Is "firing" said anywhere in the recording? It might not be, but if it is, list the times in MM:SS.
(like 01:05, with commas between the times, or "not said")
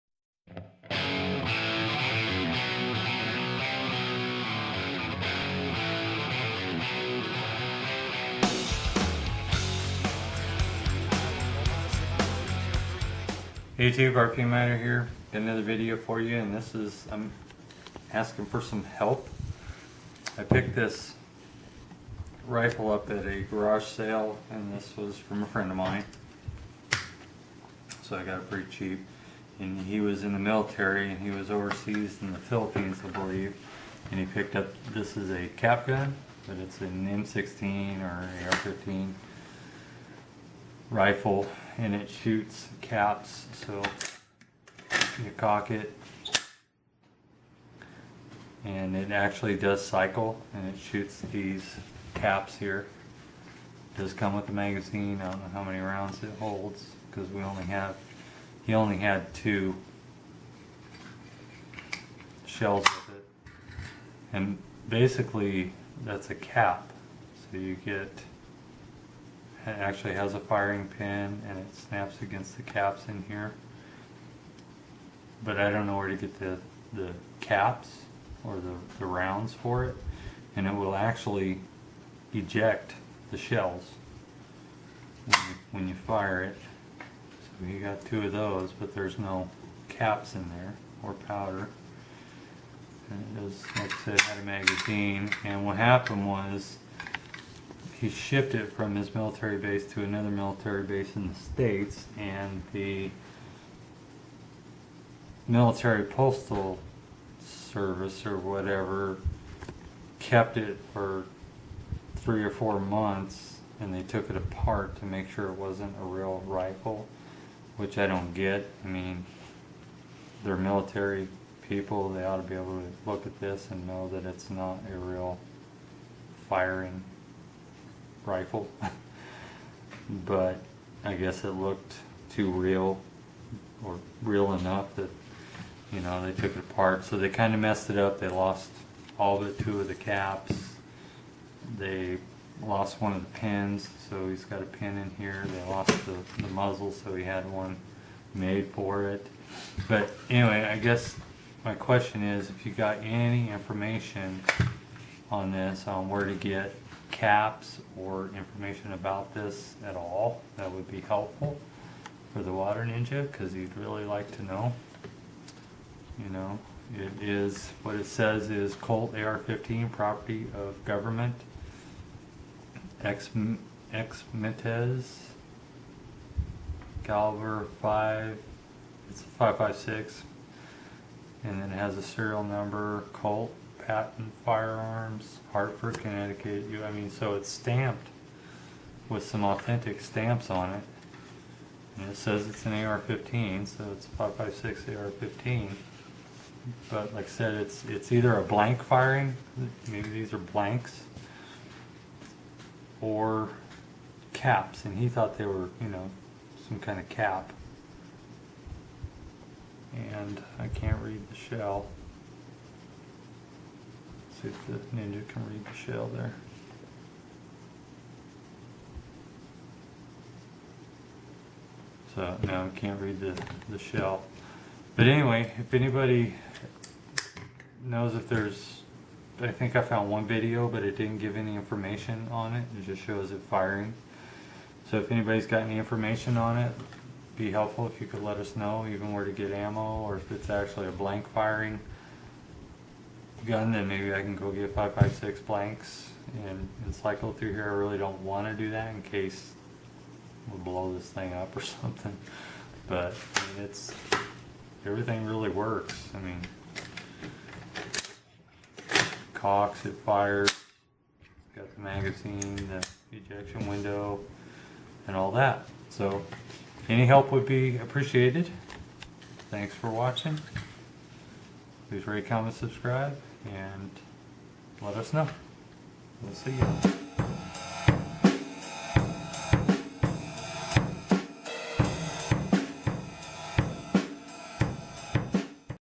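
01:10, 02:06, 03:18, 03:53, 04:01.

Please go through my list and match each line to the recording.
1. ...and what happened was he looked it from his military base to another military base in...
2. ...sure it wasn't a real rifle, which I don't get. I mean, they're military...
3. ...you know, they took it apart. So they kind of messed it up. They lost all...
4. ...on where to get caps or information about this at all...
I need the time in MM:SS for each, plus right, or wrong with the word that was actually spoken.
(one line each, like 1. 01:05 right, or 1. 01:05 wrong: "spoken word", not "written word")
1. 01:35 wrong: "shipped", not "looked"
2. 01:55 right
3. 02:15 right
4. 02:35 right.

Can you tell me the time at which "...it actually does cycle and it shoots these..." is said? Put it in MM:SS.
00:48.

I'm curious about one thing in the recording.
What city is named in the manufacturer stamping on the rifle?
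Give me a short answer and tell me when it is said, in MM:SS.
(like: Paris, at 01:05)
Hartford, Connecticut, at 03:05.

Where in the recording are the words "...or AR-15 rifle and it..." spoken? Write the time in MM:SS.
00:38.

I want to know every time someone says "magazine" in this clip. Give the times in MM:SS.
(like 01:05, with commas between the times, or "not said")
00:54, 01:34, 04:21.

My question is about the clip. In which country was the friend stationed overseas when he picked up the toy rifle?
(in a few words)
Philippines.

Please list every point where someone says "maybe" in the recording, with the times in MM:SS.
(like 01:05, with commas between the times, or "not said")
03:19, 04:03.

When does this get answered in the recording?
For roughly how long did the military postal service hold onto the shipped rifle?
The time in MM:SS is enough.
01:52.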